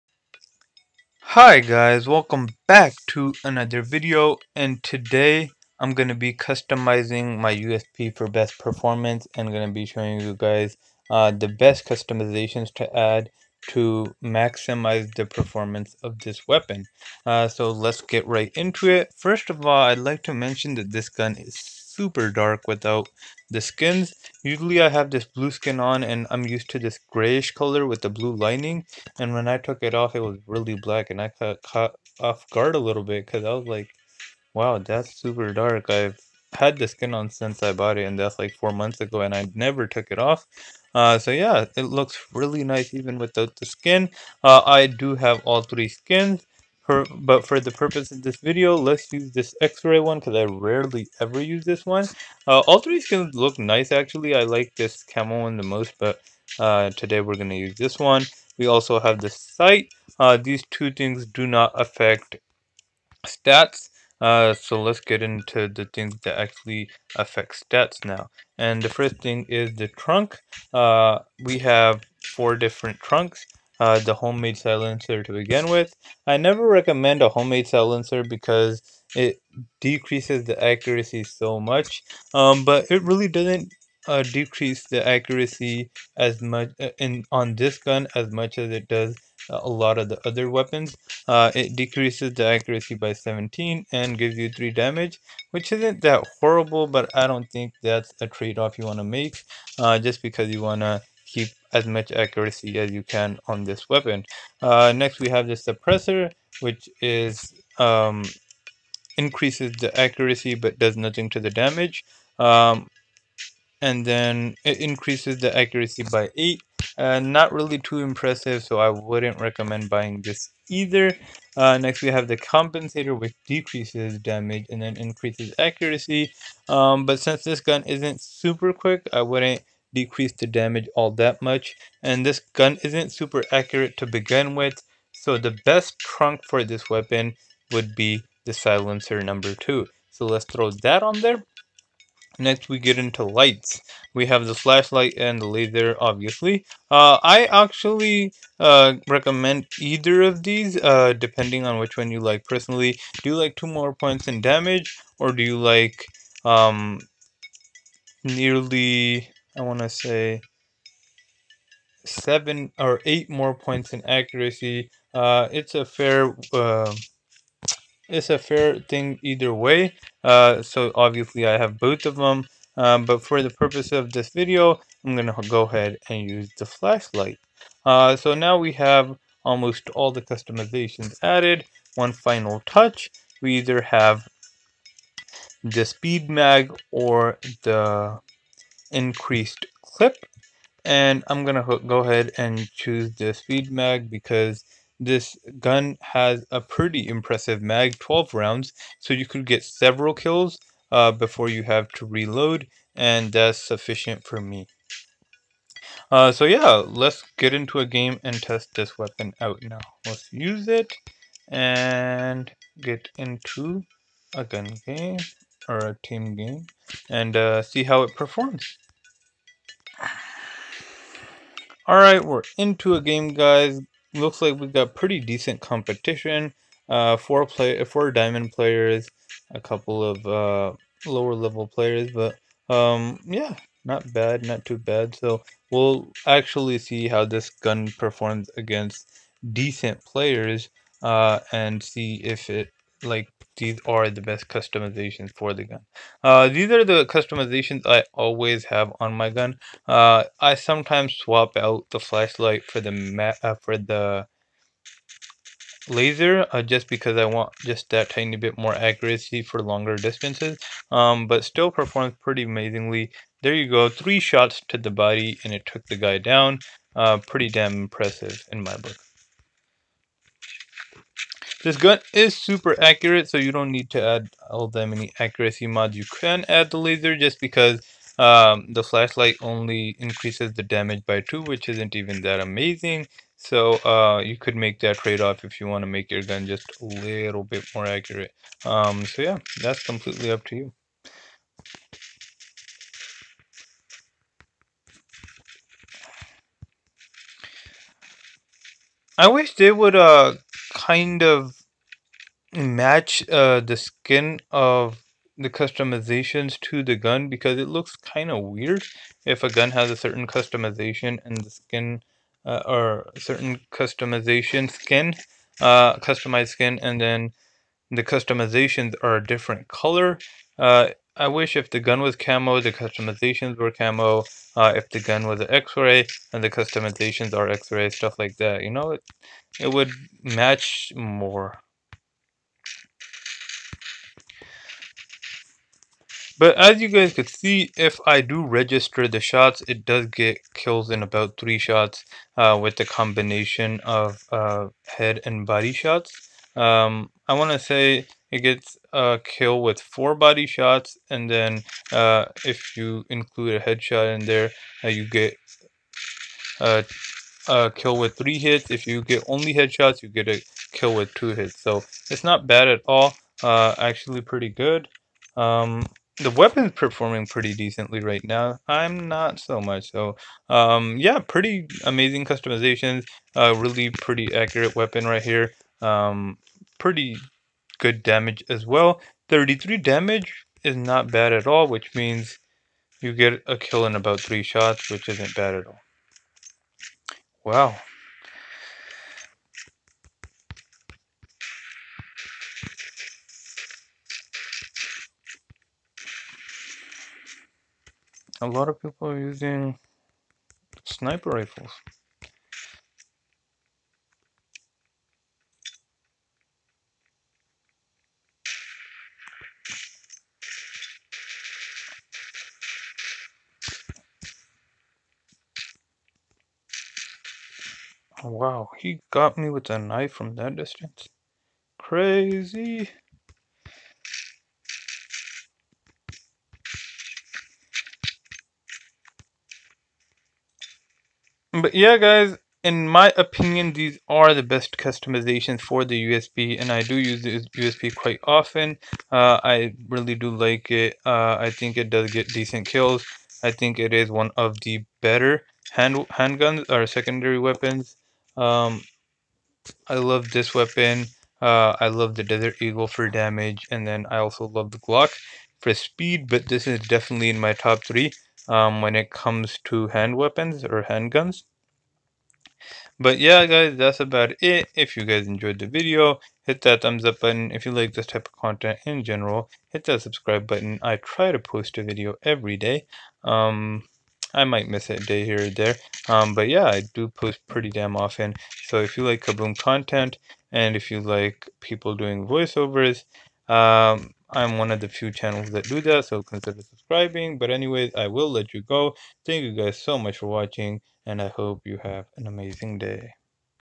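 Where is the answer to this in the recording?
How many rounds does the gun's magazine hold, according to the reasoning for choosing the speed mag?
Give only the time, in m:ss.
3:17.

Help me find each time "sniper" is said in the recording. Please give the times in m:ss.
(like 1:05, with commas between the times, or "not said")
6:40.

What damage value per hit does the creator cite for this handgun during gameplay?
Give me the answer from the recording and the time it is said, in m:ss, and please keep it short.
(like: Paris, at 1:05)
33, at 6:19.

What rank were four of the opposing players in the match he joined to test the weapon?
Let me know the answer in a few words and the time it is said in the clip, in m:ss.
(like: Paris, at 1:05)
diamond, at 3:48.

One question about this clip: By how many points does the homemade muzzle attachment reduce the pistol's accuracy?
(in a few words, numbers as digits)
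17.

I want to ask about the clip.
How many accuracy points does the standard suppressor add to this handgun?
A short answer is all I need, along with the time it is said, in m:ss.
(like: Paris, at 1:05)
8, at 1:56.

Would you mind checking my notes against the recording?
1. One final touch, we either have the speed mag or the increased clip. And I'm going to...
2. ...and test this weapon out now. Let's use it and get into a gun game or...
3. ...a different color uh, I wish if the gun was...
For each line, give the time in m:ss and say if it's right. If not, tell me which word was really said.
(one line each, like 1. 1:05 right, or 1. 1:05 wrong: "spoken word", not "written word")
1. 3:01 right
2. 3:28 right
3. 5:19 right.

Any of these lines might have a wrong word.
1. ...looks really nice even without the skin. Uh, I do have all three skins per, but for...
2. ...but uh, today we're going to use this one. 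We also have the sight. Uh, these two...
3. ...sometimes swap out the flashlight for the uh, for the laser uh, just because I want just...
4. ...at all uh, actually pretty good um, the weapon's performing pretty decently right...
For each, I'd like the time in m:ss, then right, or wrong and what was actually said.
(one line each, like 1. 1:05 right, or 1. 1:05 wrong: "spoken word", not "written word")
1. 0:41 right
2. 0:55 right
3. 4:10 right
4. 6:02 right.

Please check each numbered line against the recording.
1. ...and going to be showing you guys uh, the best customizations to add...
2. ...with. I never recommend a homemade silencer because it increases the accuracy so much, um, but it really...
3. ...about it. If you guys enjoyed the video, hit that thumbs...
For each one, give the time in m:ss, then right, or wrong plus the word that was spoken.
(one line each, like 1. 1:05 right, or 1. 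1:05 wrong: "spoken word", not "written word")
1. 0:09 right
2. 1:15 wrong: "decreases", not "increases"
3. 7:43 right.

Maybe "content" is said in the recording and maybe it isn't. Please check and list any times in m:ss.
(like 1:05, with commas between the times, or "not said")
7:48, 7:59.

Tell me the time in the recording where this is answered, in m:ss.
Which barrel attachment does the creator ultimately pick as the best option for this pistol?
2:18.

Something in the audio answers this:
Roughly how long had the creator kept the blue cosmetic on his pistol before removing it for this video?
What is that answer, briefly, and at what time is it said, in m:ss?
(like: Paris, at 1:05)
4 months, at 0:38.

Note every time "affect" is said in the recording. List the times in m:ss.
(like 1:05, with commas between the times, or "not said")
1:01, 1:07.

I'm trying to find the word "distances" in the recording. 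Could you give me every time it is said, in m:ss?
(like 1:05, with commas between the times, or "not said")
4:19, 7:00.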